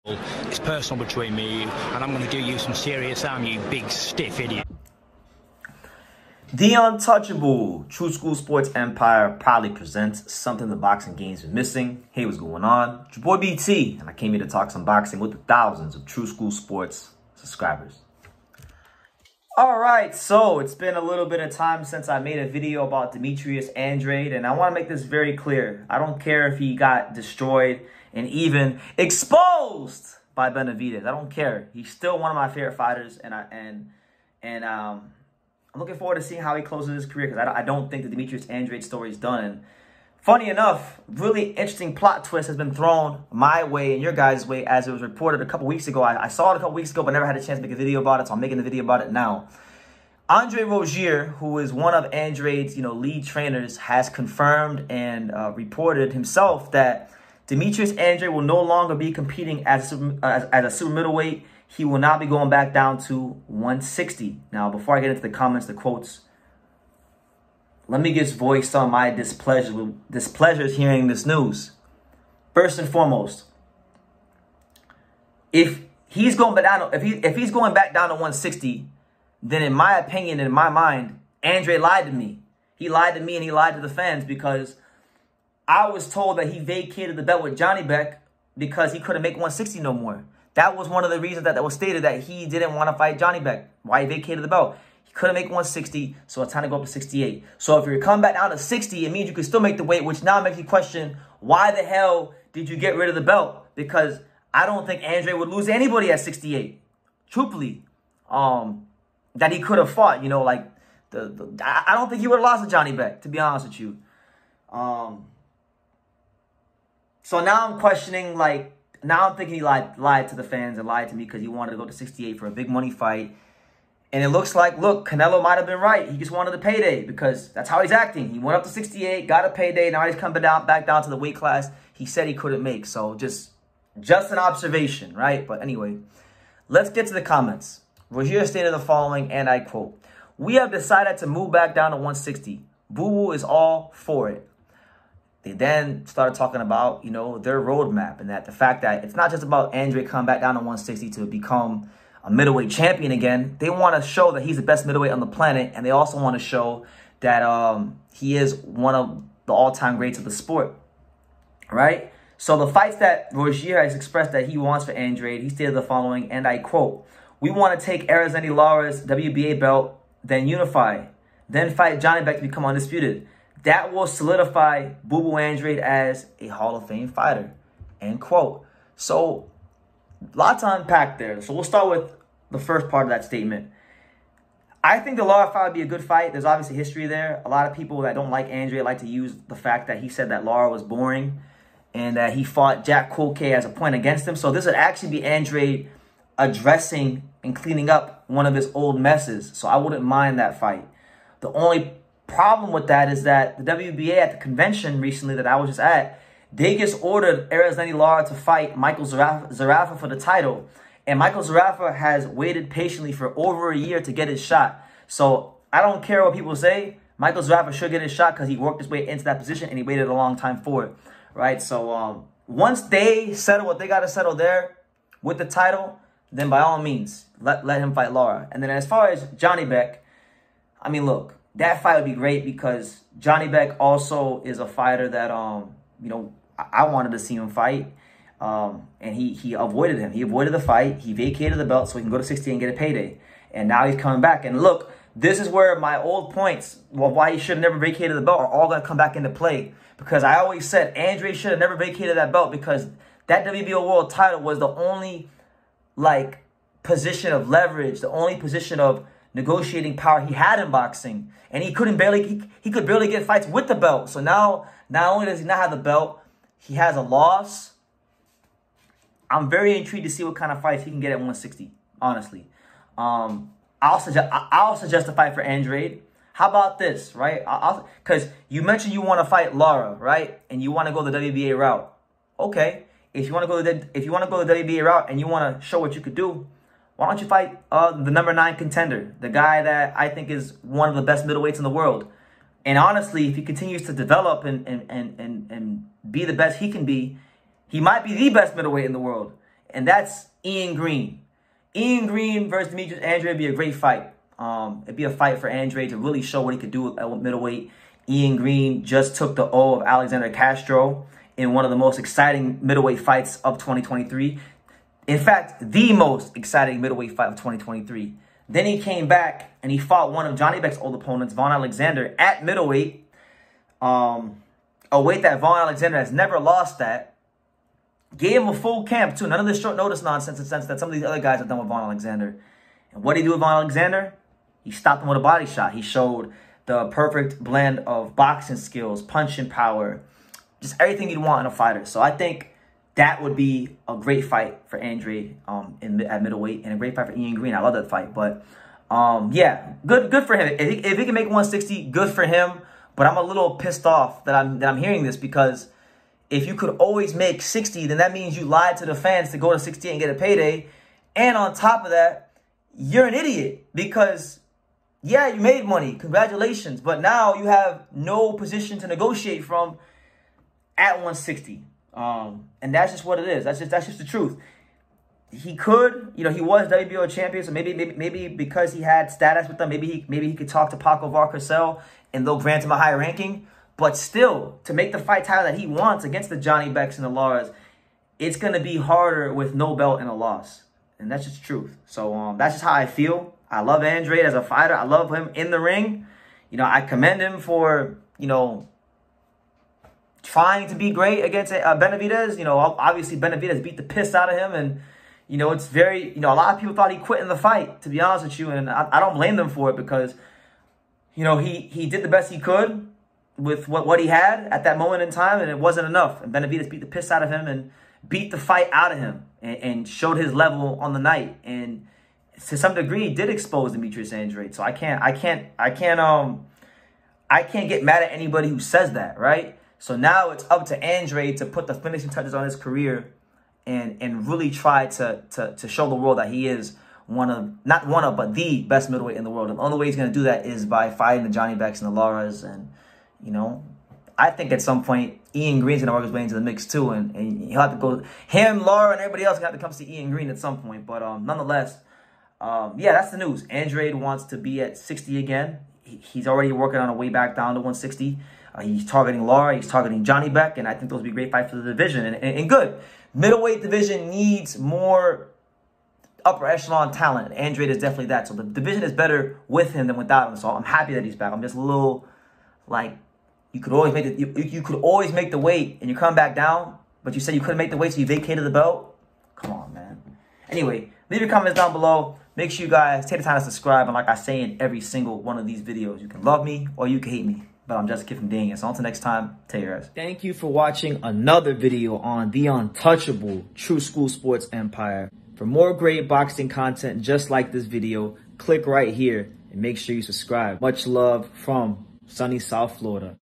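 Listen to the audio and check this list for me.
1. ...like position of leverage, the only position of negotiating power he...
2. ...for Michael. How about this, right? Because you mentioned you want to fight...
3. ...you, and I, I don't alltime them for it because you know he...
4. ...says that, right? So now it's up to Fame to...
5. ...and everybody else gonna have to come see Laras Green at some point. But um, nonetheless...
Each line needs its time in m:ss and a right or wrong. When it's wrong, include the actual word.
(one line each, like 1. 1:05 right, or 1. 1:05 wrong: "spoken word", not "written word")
1. 4:15 right
2. 4:35 wrong: "Andrade", not "Michael"
3. 6:48 wrong: "blame", not "alltime"
4. 7:08 wrong: "Andre", not "Fame"
5. 7:28 wrong: "Ian", not "Laras".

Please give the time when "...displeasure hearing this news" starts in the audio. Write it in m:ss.
1:10.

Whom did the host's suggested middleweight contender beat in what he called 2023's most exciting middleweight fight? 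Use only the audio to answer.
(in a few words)
Alexander Castro.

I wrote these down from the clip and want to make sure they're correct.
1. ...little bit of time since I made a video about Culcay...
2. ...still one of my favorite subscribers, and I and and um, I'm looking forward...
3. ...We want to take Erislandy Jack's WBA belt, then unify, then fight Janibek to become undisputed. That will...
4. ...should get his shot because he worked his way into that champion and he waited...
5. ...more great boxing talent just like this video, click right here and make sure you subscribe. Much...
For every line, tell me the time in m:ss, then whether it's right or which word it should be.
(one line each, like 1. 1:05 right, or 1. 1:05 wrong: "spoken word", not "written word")
1. 0:21 wrong: "Demetrius", not "Culcay"
2. 0:31 wrong: "fighters", not "subscribers"
3. 2:47 wrong: "Lara", not "Jack"
4. 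3:37 wrong: "position", not "champion"
5. 8:15 wrong: "content", not "talent".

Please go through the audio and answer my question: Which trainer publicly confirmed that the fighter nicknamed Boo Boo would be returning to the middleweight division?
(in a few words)
Andre Rozier.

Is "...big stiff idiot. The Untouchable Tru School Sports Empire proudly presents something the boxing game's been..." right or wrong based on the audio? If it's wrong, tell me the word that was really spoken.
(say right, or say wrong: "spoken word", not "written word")
right.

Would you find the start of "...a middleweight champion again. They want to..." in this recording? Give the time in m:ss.
2:32.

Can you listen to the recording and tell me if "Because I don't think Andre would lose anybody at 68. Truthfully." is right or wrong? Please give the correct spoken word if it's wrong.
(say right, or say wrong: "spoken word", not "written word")
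right.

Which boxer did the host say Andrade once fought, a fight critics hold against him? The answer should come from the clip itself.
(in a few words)
Jack Culcay.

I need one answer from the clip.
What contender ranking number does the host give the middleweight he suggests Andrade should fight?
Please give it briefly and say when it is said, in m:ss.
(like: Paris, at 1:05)
9, at 4:48.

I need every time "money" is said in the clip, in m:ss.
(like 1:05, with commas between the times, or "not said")
2:02, 6:05.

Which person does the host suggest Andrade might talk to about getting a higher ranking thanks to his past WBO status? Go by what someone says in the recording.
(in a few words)
Paco Valcarcel.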